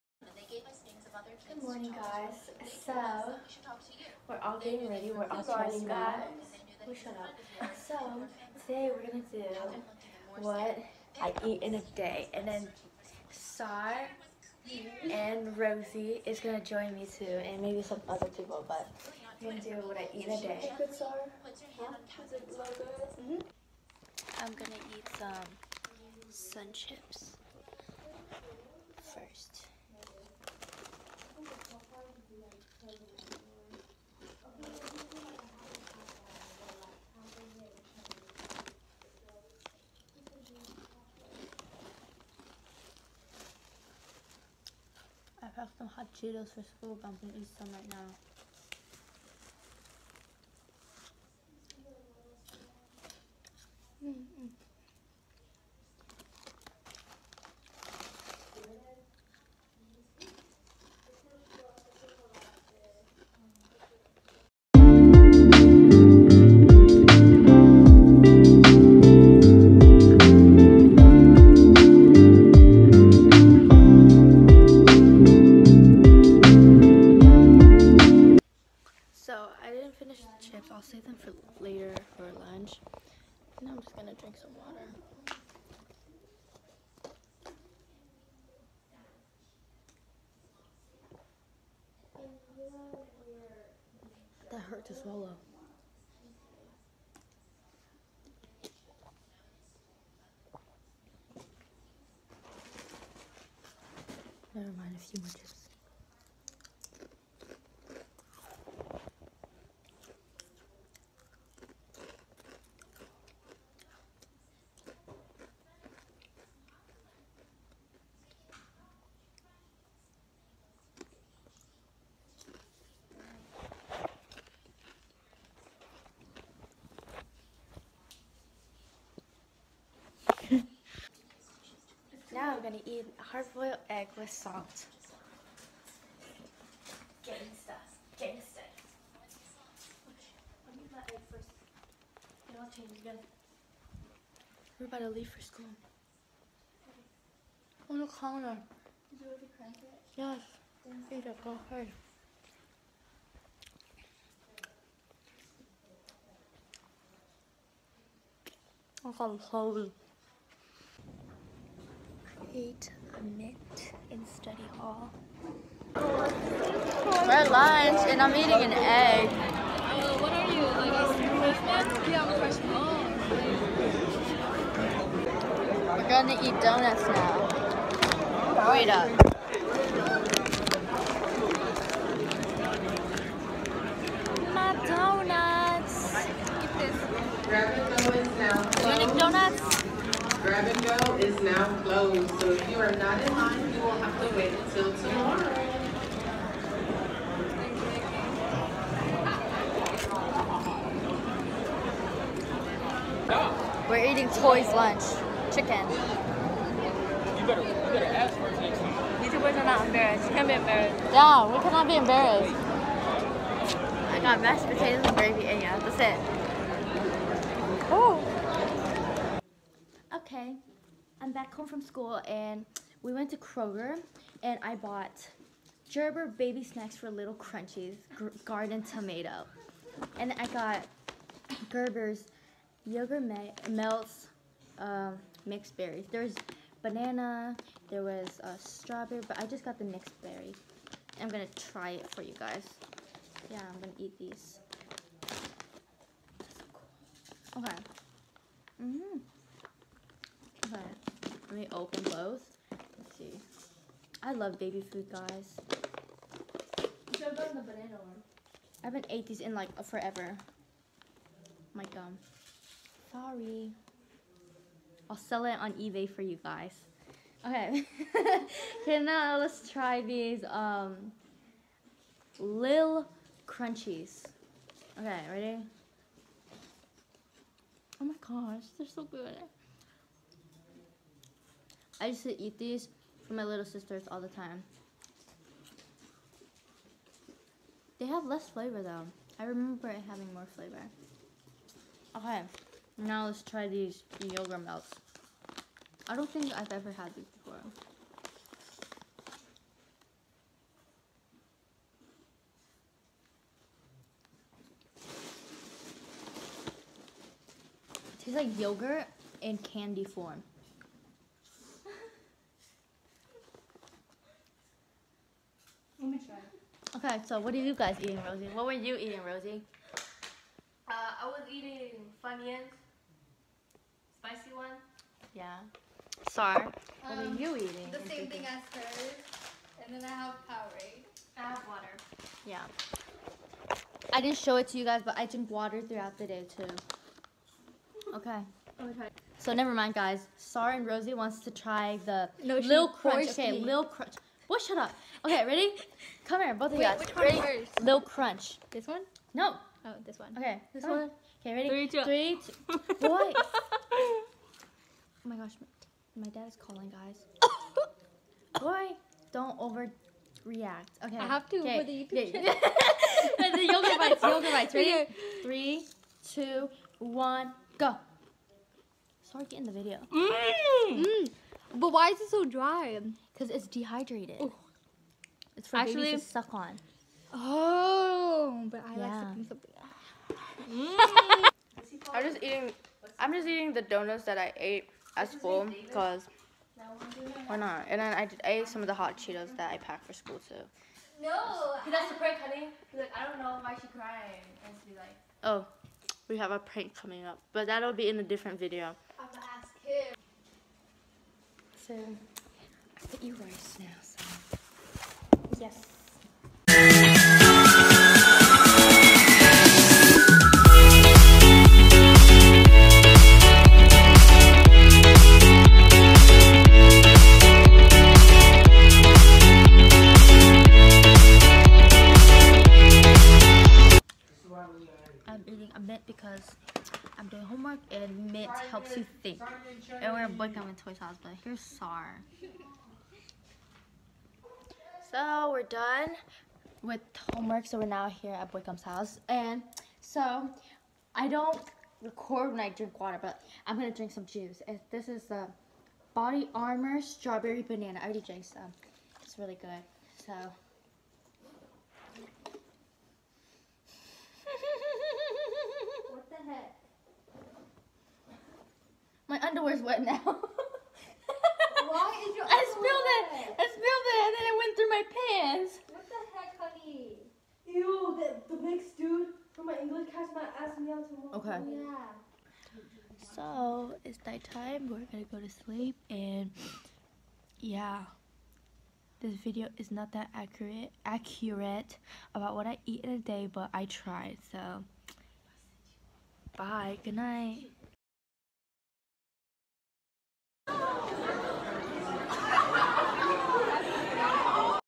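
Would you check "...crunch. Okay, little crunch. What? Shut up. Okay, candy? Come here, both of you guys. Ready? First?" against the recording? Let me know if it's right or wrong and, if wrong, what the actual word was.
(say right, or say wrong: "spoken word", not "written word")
wrong: "ready", not "candy".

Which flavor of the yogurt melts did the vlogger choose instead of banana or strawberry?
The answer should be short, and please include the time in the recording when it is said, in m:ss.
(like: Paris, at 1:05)
Mixed berries, at 3:55.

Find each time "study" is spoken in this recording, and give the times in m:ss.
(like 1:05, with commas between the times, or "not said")
2:44.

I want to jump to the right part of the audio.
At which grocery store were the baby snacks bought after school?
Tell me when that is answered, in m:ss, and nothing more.
3:43.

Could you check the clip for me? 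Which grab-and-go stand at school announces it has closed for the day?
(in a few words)
Dominic donuts.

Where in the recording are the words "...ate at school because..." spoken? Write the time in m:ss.
6:24.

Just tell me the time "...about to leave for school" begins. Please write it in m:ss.
2:24.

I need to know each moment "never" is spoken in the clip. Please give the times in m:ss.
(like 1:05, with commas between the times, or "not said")
1:44, 5:39.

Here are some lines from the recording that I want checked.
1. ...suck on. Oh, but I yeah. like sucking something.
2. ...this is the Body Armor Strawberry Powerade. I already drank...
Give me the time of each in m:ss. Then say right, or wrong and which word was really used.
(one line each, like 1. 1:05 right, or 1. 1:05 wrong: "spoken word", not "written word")
1. 6:16 right
2. 7:24 wrong: "Banana", not "Powerade".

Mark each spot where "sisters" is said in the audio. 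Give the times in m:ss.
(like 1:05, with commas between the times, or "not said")
4:43.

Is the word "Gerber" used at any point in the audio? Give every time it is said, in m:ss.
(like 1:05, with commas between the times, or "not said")
3:45, 3:51.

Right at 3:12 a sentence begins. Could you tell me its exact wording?
So if you are not in line, you will have to wait until tomorrow.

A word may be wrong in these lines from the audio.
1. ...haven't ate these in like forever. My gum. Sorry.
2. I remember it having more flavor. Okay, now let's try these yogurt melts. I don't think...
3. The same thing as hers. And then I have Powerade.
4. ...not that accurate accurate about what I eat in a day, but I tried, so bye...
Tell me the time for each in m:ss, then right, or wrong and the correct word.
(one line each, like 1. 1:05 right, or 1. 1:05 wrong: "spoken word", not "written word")
1. 4:18 right
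2. 4:49 right
3. 5:27 right
4. 7:59 right.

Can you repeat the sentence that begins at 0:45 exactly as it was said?
some hot Cheetos for school, but I'm gonna eat some right now.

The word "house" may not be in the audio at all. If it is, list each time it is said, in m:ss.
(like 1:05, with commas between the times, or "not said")
7:10, 7:18.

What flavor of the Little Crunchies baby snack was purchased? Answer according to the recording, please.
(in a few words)
Garden tomato.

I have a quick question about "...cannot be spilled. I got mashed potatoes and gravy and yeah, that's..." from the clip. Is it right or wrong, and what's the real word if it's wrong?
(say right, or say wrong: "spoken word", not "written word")
wrong: "embarrassed", not "spilled".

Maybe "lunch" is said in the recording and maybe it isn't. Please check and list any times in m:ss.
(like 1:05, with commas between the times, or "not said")
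1:22, 2:47, 3:24.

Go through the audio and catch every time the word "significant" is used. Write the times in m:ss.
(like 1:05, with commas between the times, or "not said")
not said.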